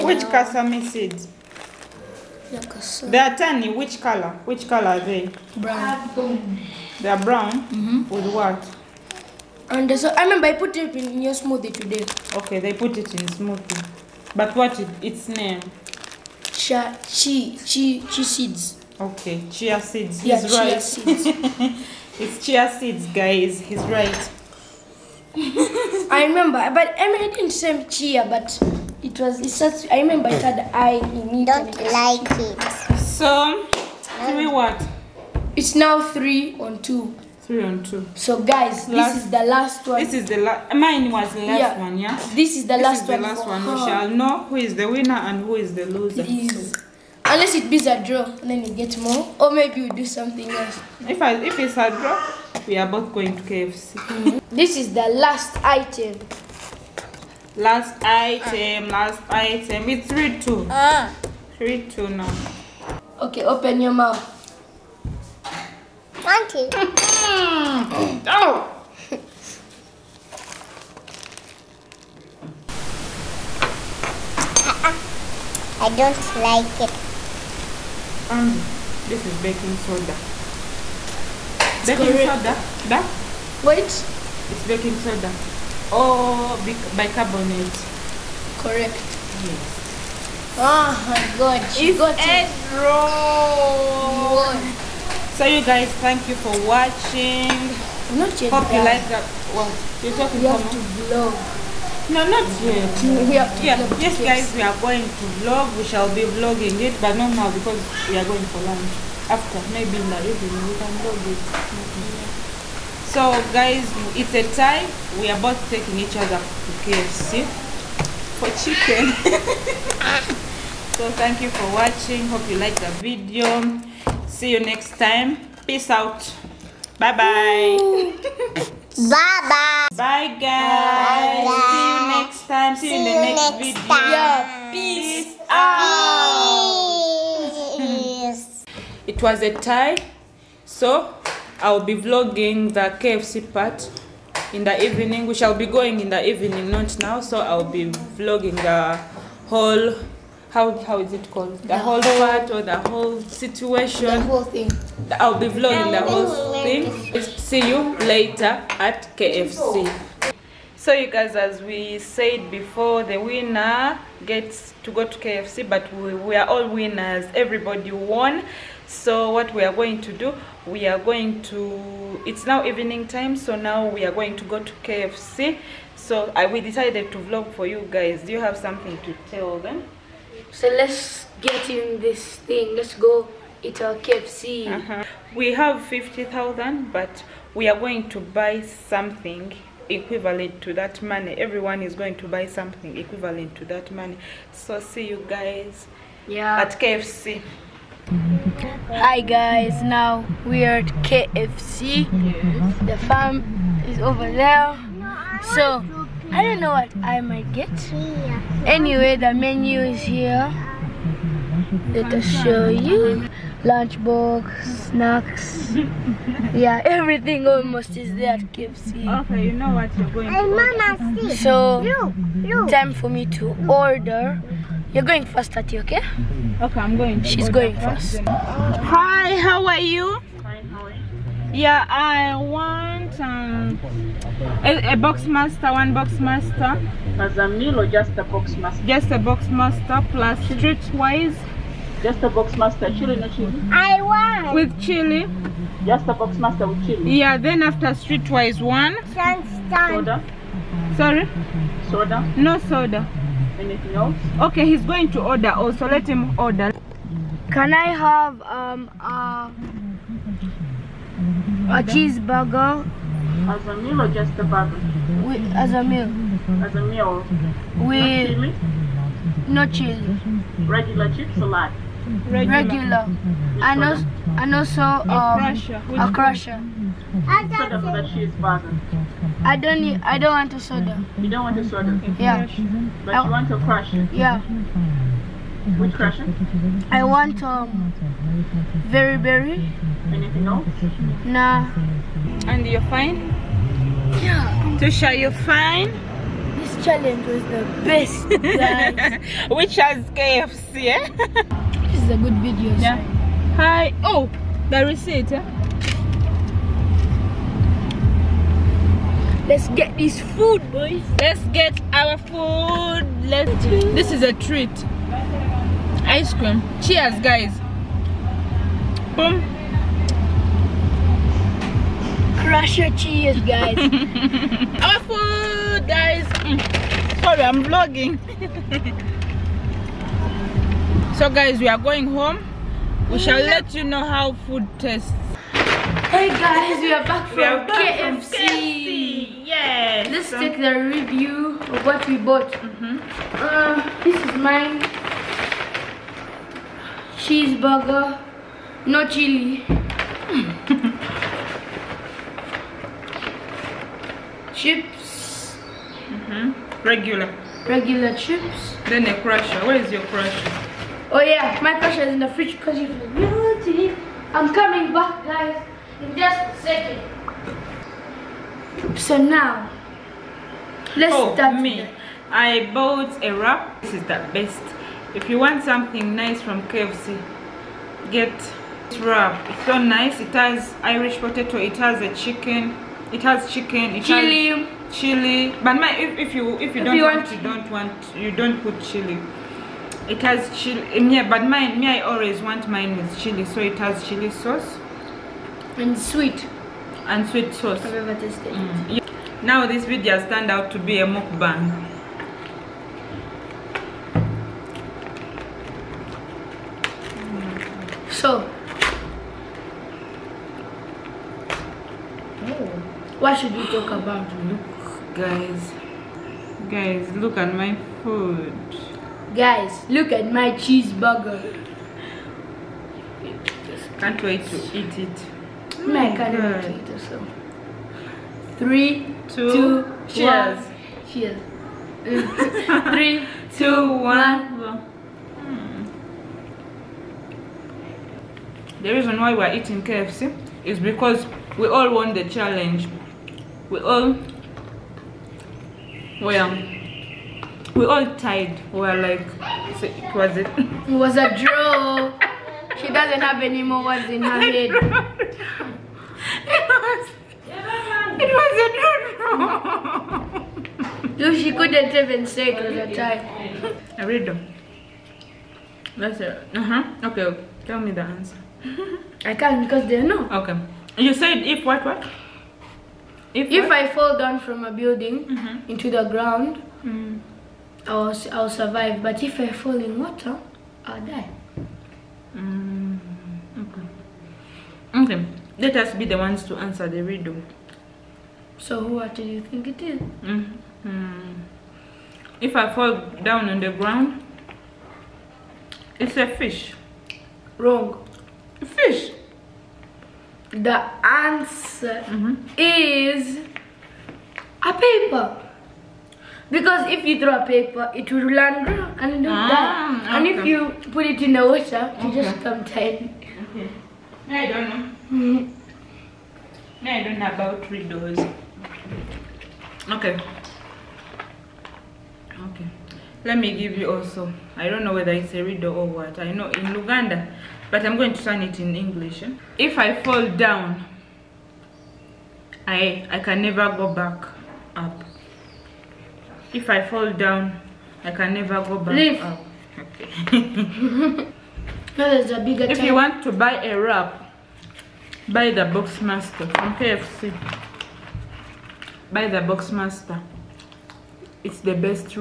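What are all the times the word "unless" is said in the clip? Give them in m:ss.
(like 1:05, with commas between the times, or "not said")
0:47.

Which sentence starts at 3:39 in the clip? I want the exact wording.
Okay, you know what you're going Mama, see.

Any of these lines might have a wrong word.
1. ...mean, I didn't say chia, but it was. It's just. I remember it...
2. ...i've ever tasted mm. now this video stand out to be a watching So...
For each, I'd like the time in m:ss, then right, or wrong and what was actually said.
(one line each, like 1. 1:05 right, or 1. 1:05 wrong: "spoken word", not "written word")
1. 0:27 right
2. 6:37 wrong: "mukbang", not "watching".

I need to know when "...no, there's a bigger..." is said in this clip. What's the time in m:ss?
9:01.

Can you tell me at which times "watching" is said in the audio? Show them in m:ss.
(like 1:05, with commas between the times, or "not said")
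1:36, 2:01.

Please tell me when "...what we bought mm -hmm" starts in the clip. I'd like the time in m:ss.
5:41.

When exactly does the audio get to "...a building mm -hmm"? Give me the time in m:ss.
7:54.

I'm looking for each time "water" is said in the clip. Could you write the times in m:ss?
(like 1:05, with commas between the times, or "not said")
7:59, 8:31.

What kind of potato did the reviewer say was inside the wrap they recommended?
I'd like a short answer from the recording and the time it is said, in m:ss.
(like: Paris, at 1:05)
Irish potato, at 6:20.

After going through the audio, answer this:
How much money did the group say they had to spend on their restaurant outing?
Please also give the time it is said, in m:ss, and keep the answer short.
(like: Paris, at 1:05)
50,000, at 3:05.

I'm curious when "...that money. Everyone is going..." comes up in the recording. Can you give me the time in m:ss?
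3:10.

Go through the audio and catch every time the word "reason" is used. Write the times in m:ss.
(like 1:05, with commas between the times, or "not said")
7:18.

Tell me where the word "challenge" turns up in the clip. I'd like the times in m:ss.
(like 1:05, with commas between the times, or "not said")
4:56, 7:22.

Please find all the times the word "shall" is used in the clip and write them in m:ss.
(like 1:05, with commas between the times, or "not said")
0:43, 1:45, 2:25, 5:33.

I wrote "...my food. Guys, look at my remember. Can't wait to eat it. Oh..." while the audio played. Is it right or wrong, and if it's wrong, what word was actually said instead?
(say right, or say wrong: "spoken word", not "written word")
wrong: "cheeseburger", not "remember".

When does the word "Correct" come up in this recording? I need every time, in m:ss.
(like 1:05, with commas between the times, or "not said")
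1:28.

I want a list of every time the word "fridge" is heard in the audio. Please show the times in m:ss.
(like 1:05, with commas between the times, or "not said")
6:02.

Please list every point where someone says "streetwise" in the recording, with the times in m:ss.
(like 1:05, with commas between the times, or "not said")
4:00, 4:07.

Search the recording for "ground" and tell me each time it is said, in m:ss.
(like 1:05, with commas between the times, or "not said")
7:56, 8:13.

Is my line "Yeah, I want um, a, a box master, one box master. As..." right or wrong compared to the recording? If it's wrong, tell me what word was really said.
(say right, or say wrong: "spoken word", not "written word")
right.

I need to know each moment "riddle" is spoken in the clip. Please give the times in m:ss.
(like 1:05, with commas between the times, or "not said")
8:07, 8:37, 8:45.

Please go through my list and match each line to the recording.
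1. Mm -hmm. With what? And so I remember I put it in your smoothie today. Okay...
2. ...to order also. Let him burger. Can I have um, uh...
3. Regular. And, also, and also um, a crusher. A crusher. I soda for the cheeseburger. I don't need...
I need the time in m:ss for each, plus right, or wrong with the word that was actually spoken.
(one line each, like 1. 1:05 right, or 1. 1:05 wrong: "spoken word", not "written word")
1. 0:07 right
2. 4:15 wrong: "order", not "burger"
3. 4:32 right.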